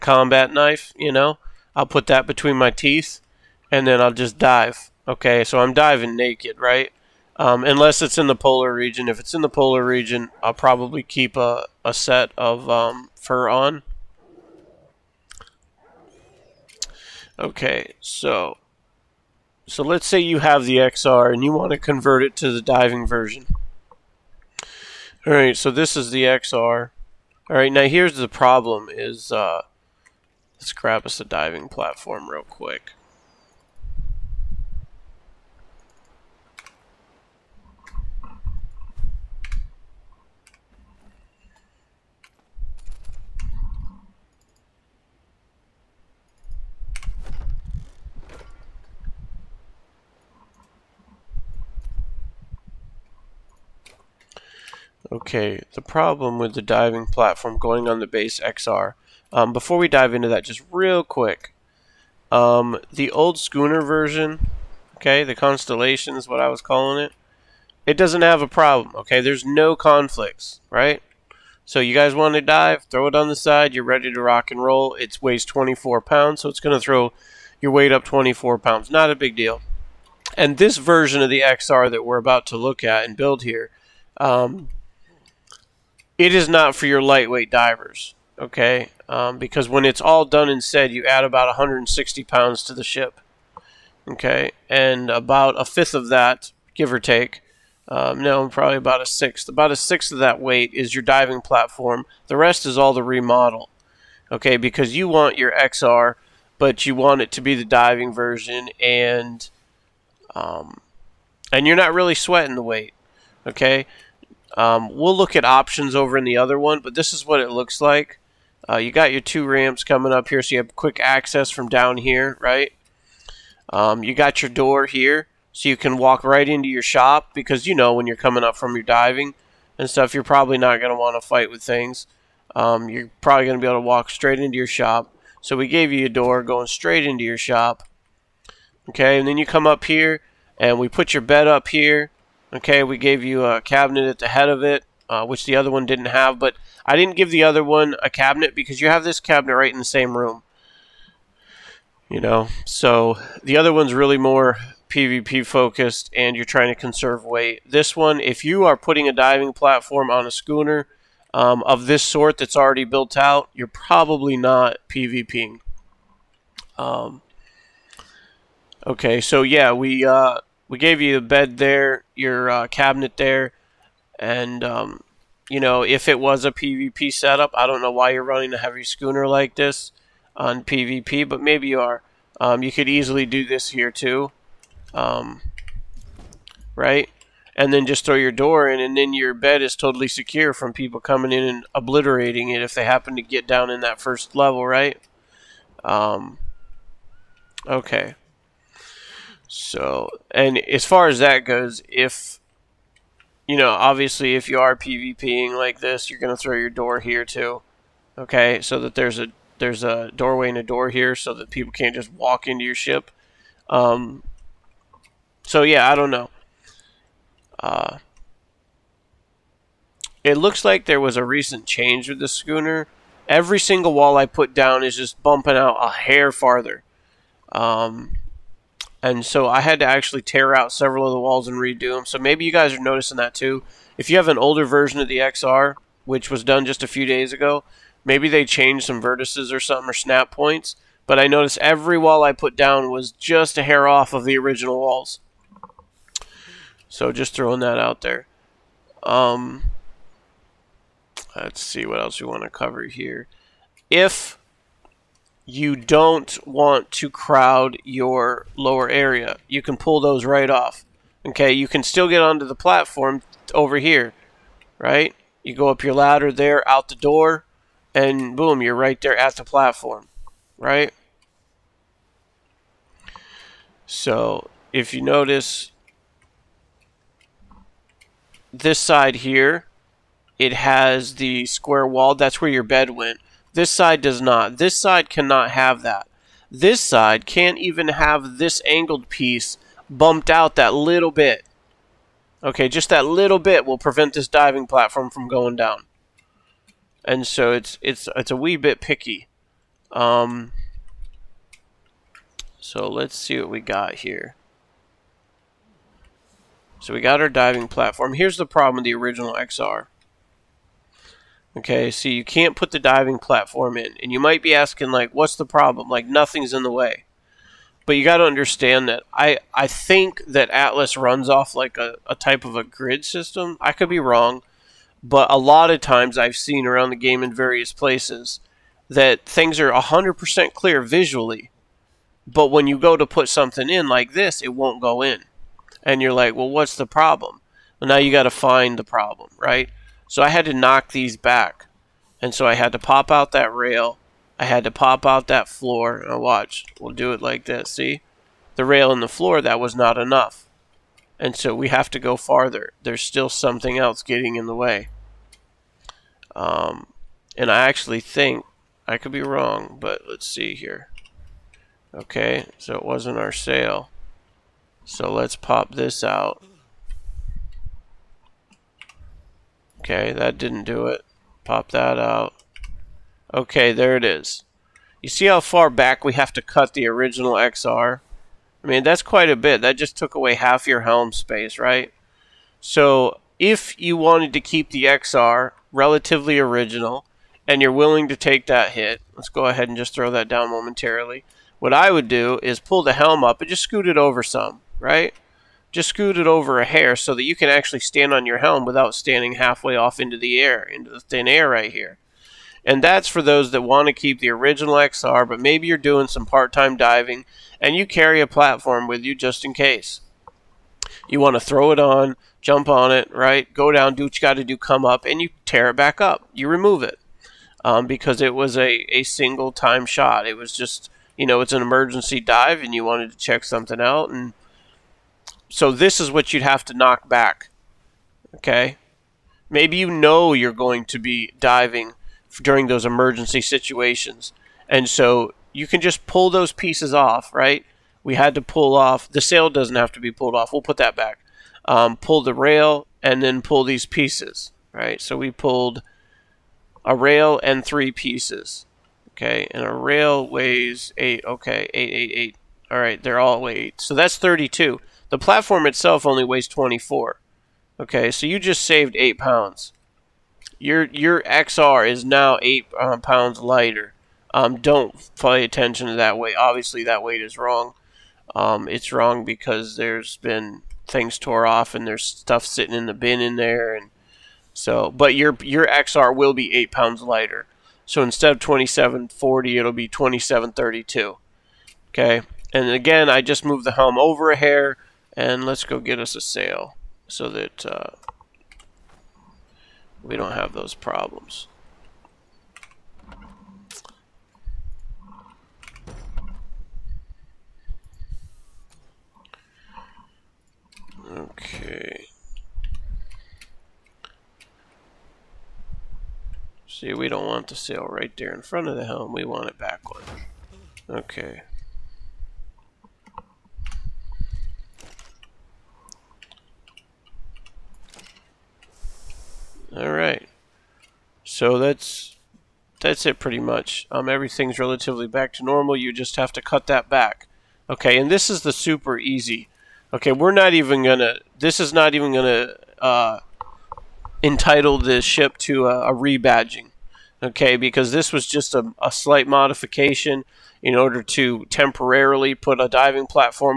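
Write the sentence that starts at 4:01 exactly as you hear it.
But I noticed every wall I put down was just a hair off of the original walls.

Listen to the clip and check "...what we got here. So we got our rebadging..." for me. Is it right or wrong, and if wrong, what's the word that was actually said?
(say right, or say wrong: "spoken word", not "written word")
wrong: "diving", not "rebadging".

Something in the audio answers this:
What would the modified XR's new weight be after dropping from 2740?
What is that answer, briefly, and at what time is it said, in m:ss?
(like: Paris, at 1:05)
2732, at 7:59.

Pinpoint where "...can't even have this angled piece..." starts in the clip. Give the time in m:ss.
4:47.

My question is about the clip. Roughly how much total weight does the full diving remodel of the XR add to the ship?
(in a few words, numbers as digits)
160 pounds.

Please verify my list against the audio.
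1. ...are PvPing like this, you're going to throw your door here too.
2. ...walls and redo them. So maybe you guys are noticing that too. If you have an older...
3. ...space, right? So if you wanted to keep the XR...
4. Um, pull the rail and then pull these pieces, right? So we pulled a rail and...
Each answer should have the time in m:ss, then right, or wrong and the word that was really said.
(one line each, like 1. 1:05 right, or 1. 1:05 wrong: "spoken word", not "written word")
1. 3:24 right
2. 3:51 right
3. 6:21 right
4. 7:21 right.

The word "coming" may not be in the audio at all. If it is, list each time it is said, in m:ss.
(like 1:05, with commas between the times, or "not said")
1:59, 2:08, 3:10.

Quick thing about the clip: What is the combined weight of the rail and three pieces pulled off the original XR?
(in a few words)
32.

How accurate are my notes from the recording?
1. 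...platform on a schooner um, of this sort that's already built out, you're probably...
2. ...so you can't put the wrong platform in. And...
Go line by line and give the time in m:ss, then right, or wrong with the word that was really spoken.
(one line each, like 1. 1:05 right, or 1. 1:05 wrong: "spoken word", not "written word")
1. 2:39 right
2. 5:11 wrong: "diving", not "wrong".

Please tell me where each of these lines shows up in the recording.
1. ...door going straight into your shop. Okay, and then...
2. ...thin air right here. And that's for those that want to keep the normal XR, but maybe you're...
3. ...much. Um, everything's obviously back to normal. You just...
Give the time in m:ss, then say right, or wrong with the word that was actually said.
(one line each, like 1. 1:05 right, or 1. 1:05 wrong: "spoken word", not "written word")
1. 2:16 right
2. 6:41 wrong: "original", not "normal"
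3. 8:43 wrong: "relatively", not "obviously".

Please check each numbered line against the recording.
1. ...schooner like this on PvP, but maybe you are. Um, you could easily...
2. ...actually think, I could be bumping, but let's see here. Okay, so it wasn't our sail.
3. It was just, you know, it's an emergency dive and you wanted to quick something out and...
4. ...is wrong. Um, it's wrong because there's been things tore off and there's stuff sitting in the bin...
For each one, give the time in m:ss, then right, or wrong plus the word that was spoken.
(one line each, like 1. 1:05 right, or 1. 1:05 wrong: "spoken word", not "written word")
1. 2:58 right
2. 5:57 wrong: "wrong", not "bumping"
3. 7:00 wrong: "check", not "quick"
4. 7:47 right.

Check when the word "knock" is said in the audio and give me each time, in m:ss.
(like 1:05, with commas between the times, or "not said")
5:40, 7:06.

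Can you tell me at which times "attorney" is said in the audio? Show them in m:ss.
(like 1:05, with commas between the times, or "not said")
not said.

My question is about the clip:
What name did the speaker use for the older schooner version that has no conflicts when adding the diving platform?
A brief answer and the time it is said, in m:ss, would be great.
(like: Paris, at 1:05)
Constellation, at 1:05.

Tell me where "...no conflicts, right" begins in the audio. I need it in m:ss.
1:09.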